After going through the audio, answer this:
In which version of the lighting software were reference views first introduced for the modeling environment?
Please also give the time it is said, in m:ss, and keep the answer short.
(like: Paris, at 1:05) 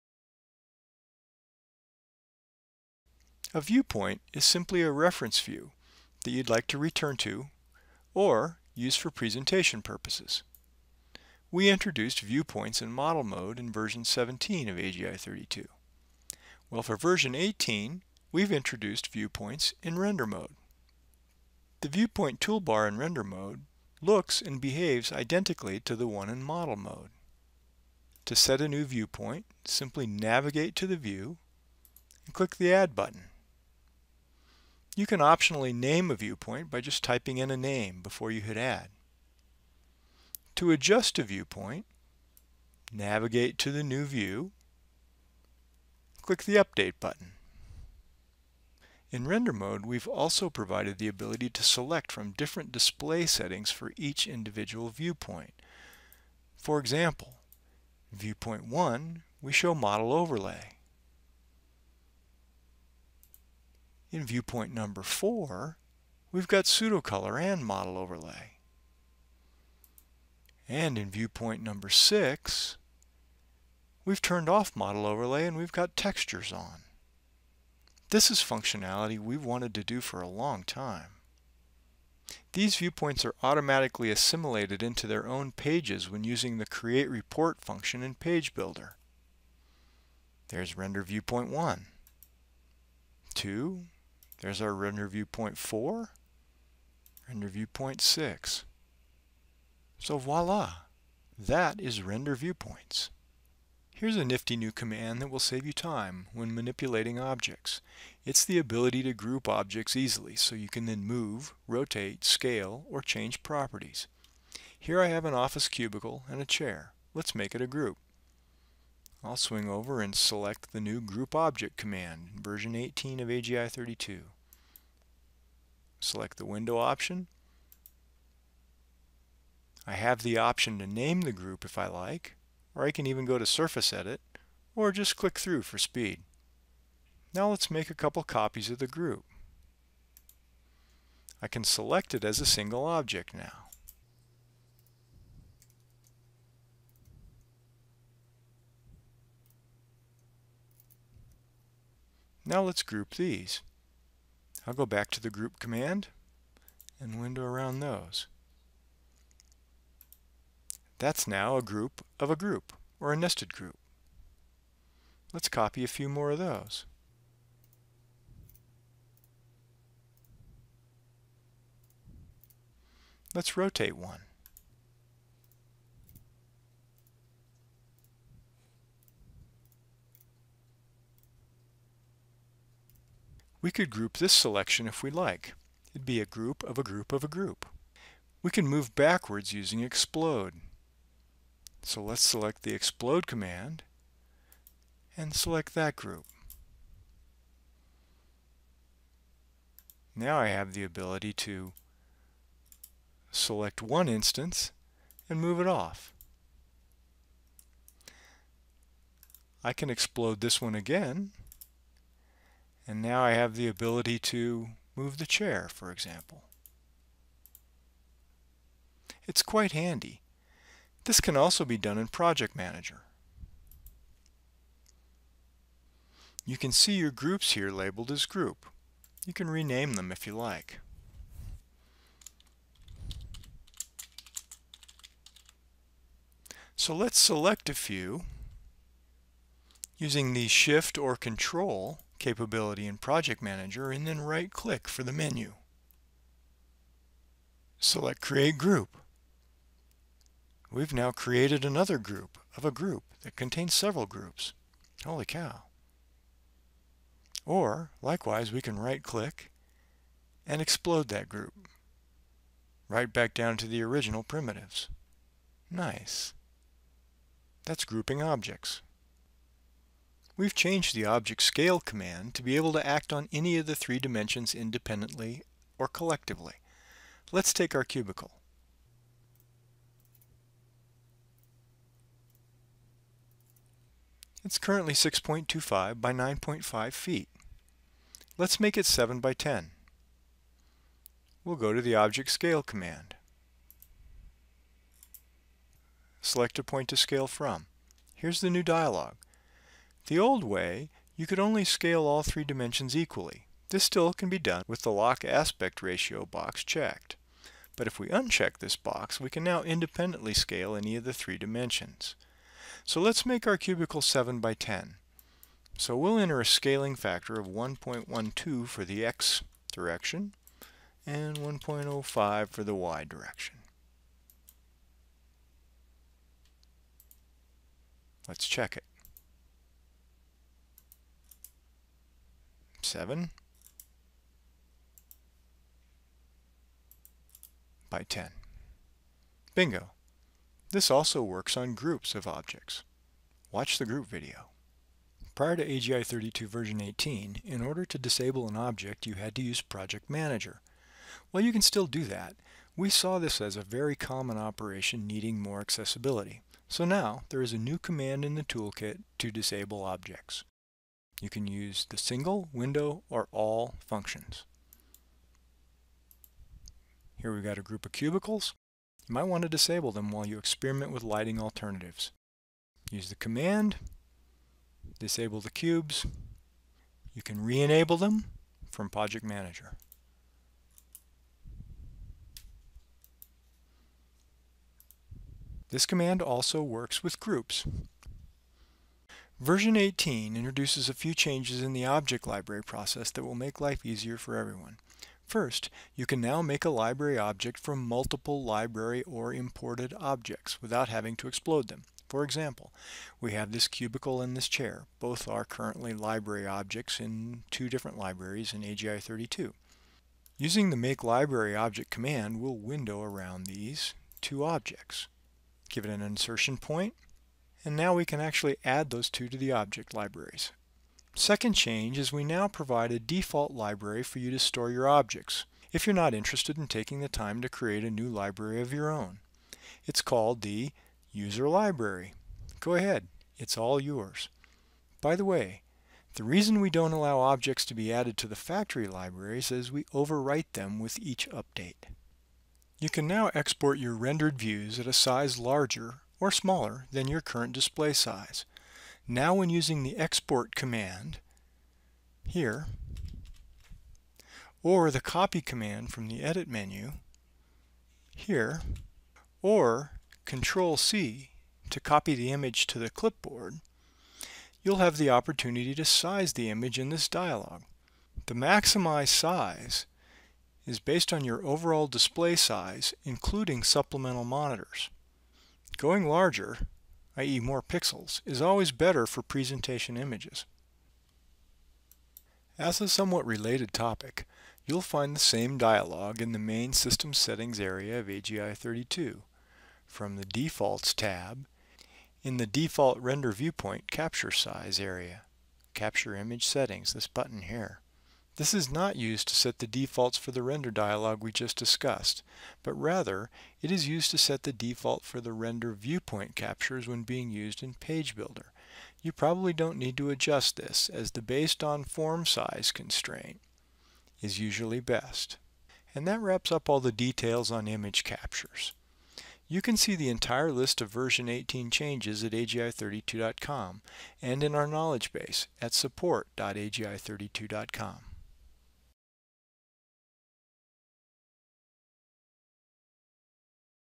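17, at 0:13.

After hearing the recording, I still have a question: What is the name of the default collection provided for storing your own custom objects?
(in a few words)
User Library.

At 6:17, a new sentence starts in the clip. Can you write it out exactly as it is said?
You can re-enable them from Project Manager.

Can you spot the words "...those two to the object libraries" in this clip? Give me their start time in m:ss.
6:58.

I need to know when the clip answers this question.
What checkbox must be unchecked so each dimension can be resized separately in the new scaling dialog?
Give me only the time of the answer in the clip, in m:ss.
5:04.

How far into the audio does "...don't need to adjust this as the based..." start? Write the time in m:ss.
8:29.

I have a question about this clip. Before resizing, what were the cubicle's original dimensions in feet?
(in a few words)
6.25 by 9.5 feet.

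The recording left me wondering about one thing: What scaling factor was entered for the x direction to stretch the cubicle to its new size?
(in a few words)
1.12.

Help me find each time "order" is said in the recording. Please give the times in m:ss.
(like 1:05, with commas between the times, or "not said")
5:47.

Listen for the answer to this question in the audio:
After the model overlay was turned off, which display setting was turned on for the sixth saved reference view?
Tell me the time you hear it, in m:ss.
1:15.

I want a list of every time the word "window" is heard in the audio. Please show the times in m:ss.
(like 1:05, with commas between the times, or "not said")
2:06, 2:37, 6:02, 6:52.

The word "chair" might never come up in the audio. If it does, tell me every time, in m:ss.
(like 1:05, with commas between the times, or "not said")
1:56, 3:35, 6:44.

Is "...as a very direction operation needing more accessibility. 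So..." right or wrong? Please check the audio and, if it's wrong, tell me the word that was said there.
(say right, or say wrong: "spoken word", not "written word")
wrong: "common", not "direction".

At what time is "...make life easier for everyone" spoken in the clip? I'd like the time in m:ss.
6:33.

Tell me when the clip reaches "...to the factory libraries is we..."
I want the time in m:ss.
7:18.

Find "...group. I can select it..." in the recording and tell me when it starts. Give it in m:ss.
2:18.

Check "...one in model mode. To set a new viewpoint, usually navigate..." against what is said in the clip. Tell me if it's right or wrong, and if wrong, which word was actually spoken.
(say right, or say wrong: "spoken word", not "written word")
wrong: "simply", not "usually".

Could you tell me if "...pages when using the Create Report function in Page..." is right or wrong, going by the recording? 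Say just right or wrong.
right.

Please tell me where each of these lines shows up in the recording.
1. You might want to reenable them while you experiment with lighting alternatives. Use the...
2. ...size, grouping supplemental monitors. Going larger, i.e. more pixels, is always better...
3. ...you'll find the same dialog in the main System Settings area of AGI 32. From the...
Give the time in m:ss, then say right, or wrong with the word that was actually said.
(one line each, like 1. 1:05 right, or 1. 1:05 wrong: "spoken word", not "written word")
1. 6:09 wrong: "disable", not "reenable"
2. 7:52 wrong: "including", not "grouping"
3. 8:04 right.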